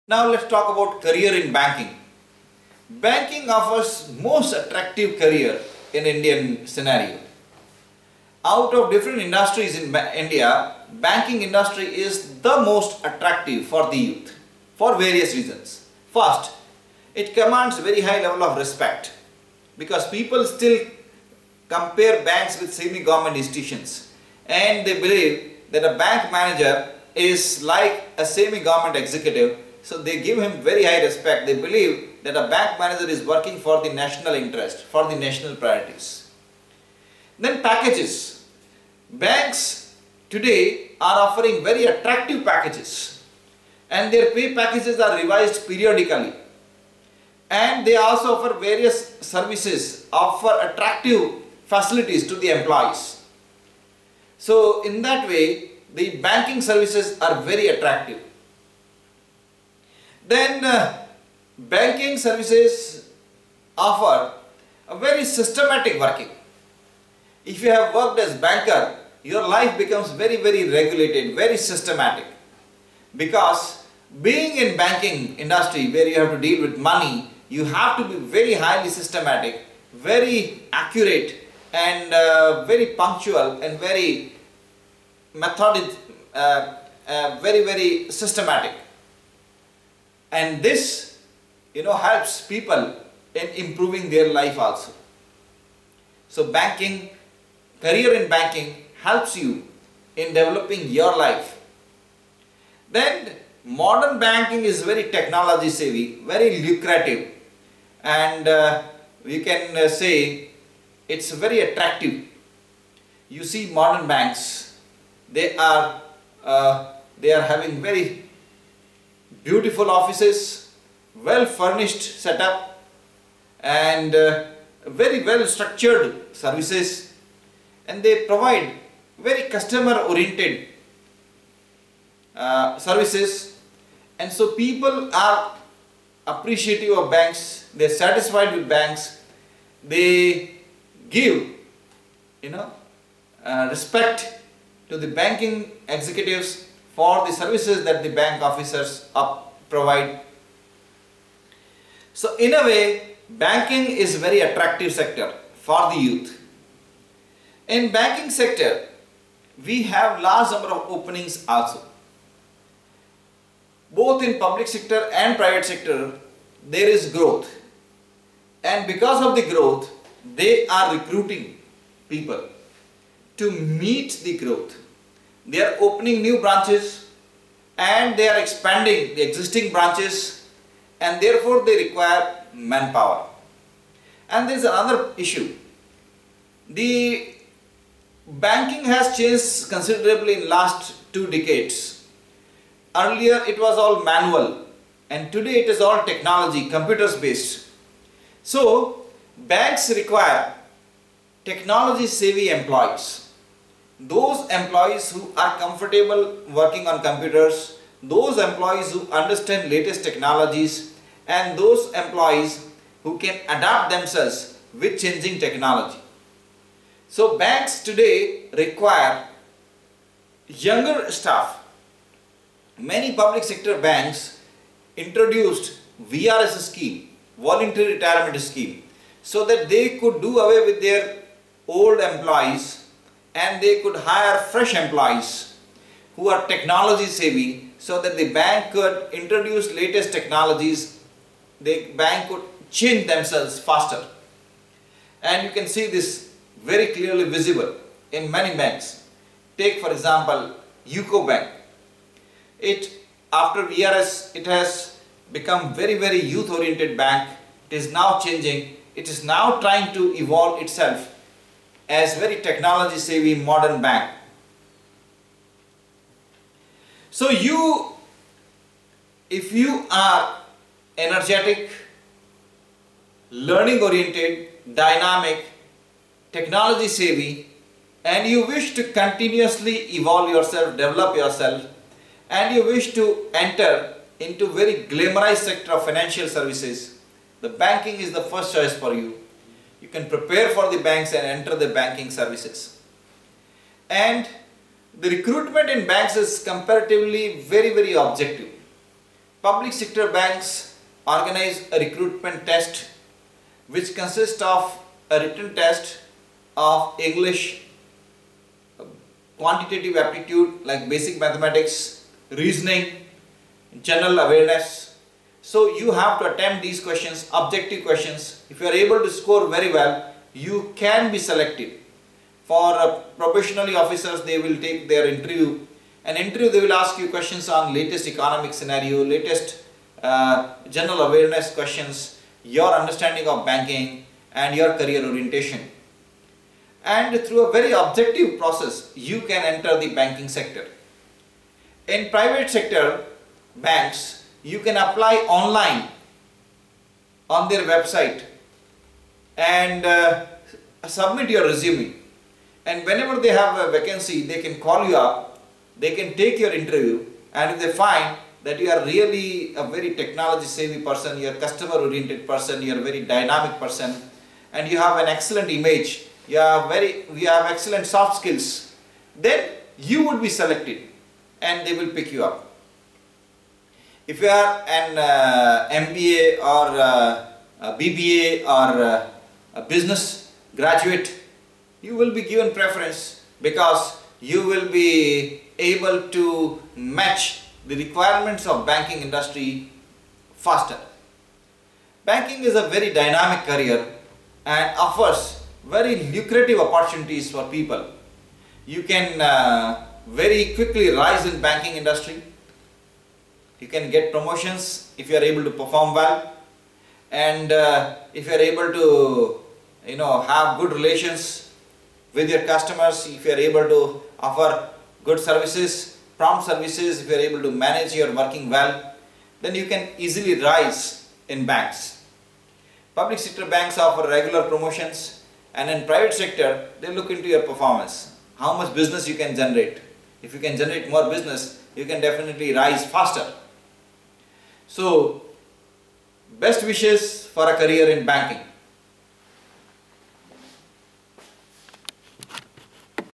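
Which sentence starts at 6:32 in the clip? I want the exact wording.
Banking is a very dynamic career and offers very lucrative opportunities for people.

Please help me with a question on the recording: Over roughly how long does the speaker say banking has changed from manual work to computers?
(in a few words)
two decades.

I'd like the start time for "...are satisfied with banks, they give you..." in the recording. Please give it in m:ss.
2:17.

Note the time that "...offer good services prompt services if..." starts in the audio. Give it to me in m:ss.
6:54.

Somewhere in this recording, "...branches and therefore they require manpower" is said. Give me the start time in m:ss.
2:59.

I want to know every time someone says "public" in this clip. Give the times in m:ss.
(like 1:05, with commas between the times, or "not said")
2:44, 3:43, 4:59, 7:02.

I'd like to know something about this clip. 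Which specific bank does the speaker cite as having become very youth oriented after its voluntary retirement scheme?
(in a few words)
UCO Bank.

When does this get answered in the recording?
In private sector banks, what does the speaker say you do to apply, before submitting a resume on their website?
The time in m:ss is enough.
5:44.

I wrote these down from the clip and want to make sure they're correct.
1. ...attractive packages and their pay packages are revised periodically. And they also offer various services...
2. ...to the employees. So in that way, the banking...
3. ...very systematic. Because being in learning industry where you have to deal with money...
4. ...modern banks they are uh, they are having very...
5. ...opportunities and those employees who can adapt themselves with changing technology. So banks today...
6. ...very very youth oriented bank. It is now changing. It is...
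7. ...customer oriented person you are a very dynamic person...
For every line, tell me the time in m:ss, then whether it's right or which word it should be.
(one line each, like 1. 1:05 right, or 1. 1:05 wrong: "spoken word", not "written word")
1. 0:41 right
2. 0:52 right
3. 1:11 wrong: "banking", not "learning"
4. 1:53 right
5. 3:30 wrong: "technologies", not "opportunities"
6. 4:15 right
7. 6:01 right.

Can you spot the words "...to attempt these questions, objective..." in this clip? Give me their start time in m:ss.
5:16.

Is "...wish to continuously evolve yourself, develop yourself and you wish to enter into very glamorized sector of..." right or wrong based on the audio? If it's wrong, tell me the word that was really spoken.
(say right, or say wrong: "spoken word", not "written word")
right.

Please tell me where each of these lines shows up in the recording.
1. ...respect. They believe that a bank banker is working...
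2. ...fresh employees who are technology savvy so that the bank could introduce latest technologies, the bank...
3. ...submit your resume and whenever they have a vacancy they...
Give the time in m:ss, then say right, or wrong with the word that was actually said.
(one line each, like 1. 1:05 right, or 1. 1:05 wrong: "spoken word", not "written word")
1. 0:31 wrong: "manager", not "banker"
2. 3:54 right
3. 5:50 right.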